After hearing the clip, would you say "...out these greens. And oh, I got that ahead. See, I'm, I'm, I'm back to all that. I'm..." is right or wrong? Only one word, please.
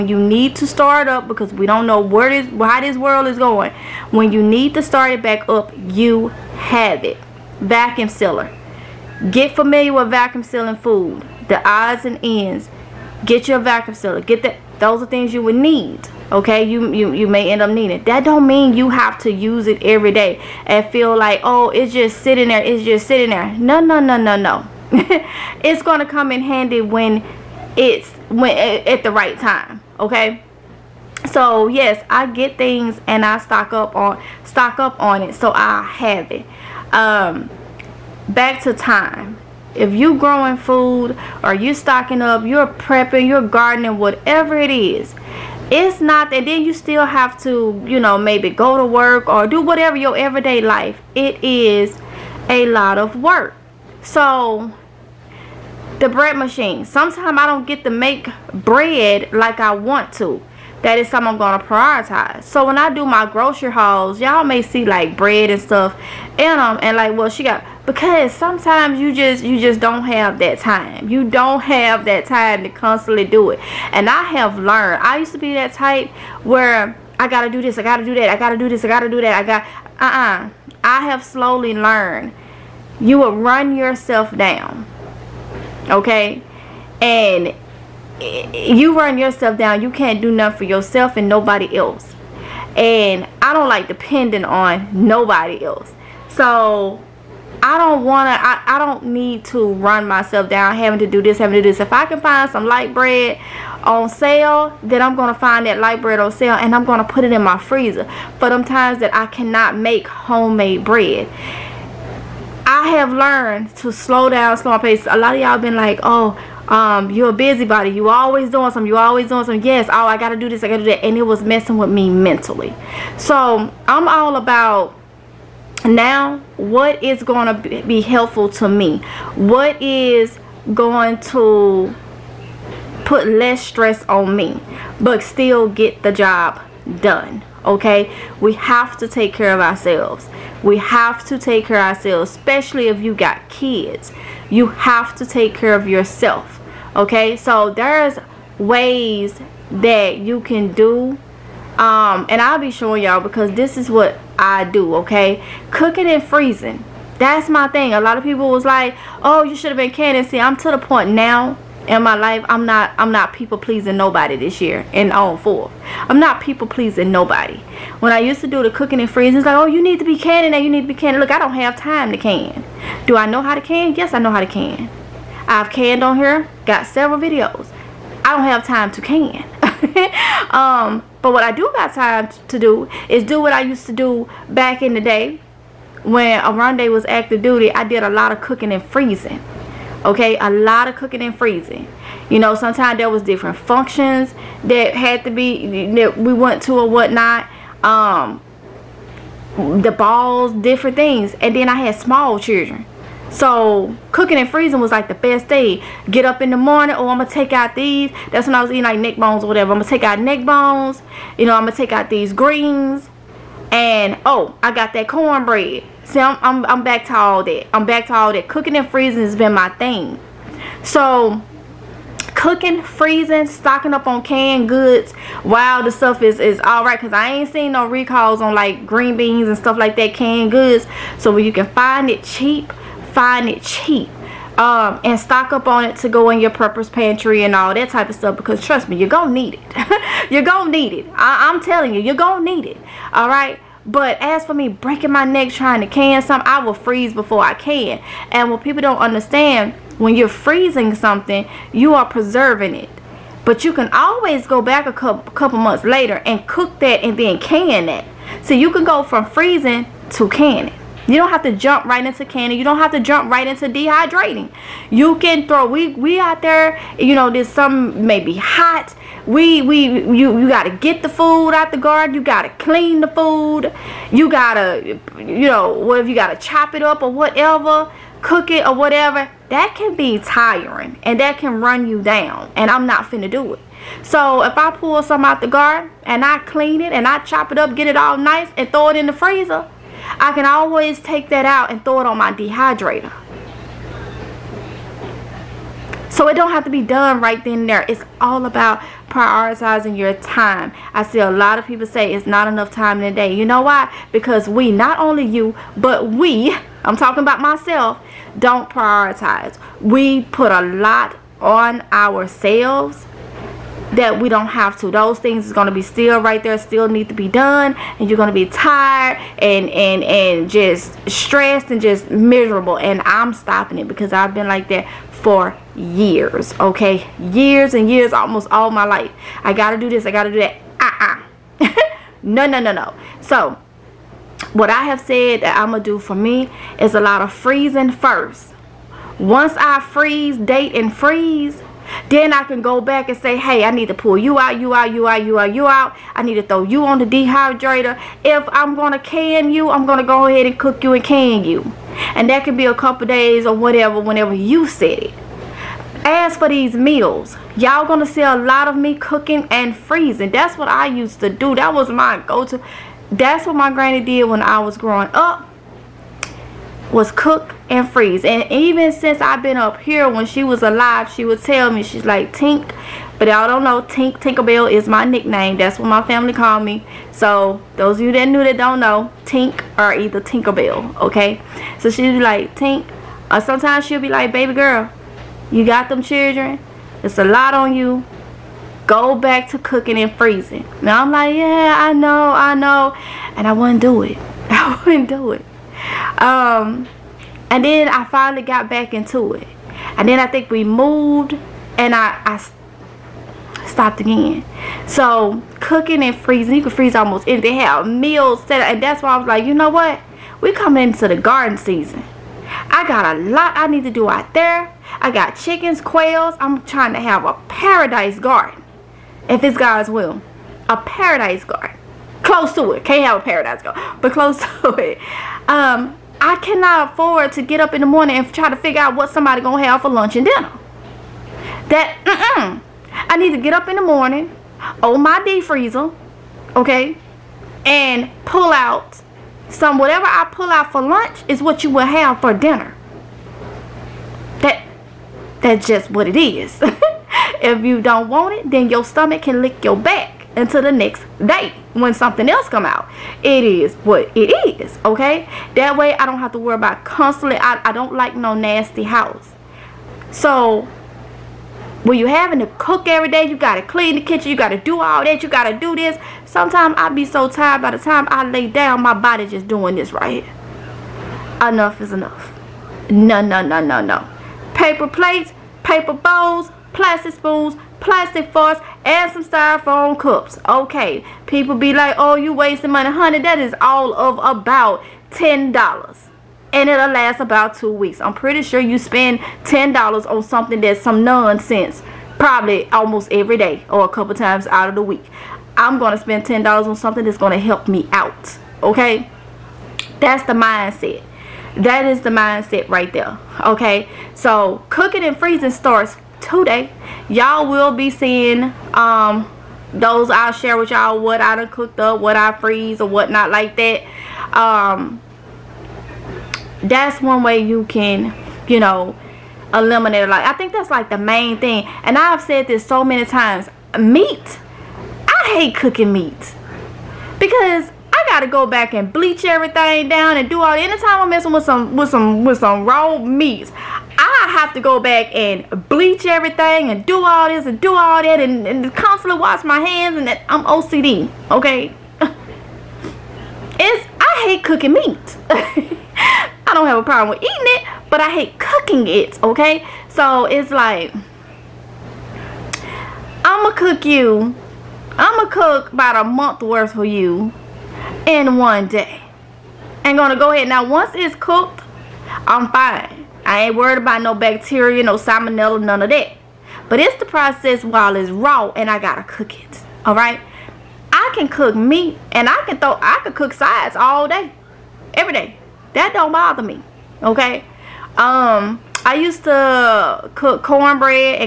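wrong.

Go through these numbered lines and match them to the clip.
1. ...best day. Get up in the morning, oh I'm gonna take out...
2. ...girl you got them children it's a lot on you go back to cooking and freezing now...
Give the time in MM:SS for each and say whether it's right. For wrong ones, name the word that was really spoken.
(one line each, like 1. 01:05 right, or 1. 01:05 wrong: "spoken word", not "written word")
1. 03:25 right
2. 06:24 right.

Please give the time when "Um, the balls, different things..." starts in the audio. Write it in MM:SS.
03:17.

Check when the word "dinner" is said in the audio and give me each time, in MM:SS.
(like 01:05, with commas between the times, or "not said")
07:10, 07:22.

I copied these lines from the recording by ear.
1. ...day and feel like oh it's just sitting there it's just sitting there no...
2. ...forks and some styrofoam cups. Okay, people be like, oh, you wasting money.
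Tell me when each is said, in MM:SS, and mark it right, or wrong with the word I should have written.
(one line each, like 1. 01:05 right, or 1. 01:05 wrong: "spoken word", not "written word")
1. 00:20 right
2. 07:58 right.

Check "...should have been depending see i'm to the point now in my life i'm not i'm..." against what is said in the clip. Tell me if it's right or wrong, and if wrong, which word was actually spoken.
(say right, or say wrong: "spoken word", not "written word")
wrong: "canning", not "depending".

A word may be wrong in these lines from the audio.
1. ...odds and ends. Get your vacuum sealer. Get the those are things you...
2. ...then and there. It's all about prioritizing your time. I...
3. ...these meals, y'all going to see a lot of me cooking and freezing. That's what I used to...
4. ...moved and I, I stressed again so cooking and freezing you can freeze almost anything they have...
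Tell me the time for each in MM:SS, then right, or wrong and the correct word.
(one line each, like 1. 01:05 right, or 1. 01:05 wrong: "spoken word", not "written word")
1. 00:11 right
2. 04:57 right
3. 05:56 right
4. 06:40 wrong: "stopped", not "stressed".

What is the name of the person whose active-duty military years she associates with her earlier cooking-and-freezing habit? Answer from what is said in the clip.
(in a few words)
Oronde.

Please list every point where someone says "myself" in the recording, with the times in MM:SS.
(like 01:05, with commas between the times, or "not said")
01:40, 05:07.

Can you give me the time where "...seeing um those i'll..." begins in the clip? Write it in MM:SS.
08:27.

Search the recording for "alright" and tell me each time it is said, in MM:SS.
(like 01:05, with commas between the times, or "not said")
03:46, 09:29.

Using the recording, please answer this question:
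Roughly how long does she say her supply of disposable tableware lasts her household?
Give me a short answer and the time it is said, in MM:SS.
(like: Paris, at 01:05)
two weeks, at 08:07.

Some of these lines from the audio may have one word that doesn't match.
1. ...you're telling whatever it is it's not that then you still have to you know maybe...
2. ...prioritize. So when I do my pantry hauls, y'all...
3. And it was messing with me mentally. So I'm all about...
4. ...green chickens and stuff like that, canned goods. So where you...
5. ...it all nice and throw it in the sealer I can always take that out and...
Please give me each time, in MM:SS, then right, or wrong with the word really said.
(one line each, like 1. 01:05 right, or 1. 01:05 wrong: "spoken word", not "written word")
1. 00:43 wrong: "gardening", not "telling"
2. 01:01 wrong: "grocery", not "pantry"
3. 02:01 right
4. 03:48 wrong: "beans", not "chickens"
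5. 04:47 wrong: "freezer", not "sealer".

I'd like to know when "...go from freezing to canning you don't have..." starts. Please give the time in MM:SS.
04:18.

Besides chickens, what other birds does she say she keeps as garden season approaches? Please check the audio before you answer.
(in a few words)
quails.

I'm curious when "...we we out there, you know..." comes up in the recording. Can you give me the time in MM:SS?
04:25.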